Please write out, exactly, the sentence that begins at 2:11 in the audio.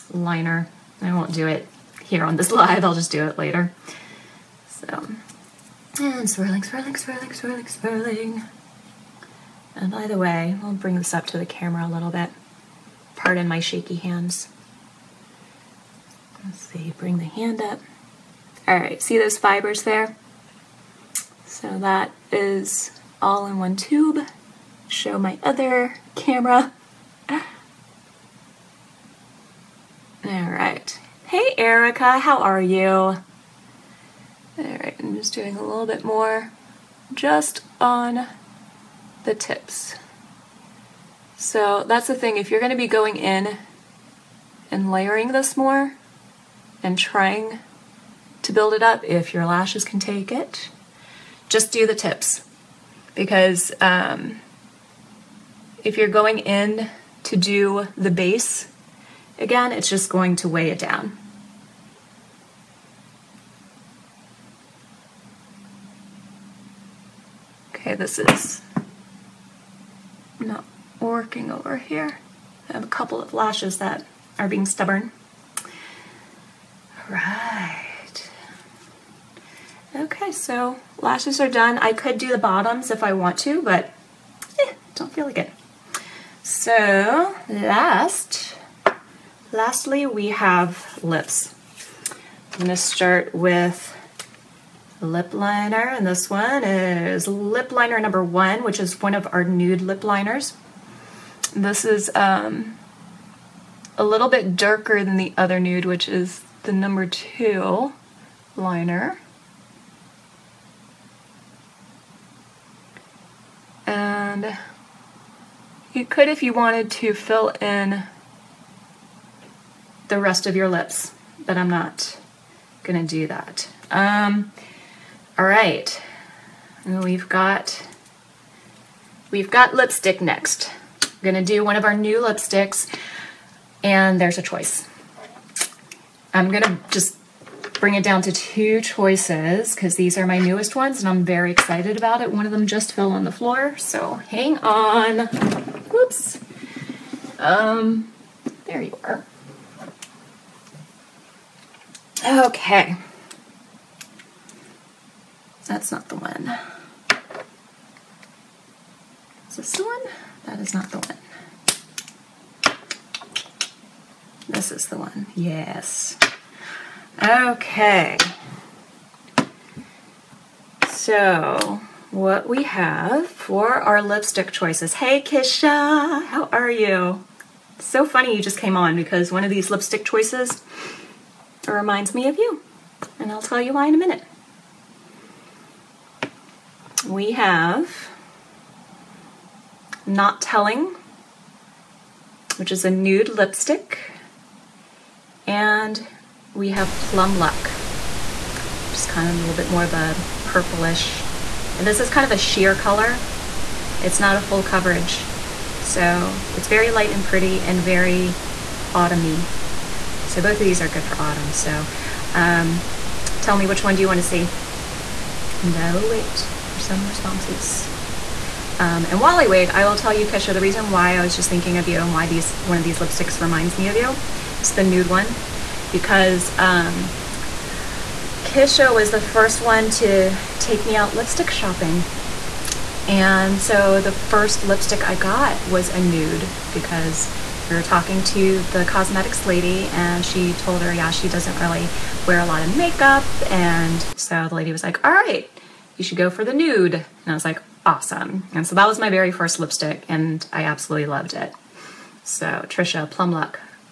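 I'm gonna do one of our new lipsticks and there's a choice.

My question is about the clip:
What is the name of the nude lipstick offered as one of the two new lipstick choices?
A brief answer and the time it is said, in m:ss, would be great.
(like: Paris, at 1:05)
Not Telling, at 3:10.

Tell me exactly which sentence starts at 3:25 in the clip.
So it's very light and pretty and very autumny.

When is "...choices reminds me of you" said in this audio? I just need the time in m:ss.
3:00.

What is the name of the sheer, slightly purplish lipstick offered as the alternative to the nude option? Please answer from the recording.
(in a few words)
Plum Luck.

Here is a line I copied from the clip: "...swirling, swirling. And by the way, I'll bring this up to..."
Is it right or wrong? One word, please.
right.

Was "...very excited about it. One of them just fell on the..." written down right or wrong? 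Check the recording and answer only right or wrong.
right.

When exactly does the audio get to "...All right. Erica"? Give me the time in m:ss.
0:30.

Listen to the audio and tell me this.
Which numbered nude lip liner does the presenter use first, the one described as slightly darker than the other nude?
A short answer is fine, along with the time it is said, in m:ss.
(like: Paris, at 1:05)
1, at 1:37.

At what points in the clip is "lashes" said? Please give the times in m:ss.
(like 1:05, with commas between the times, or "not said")
0:49, 1:13, 1:20.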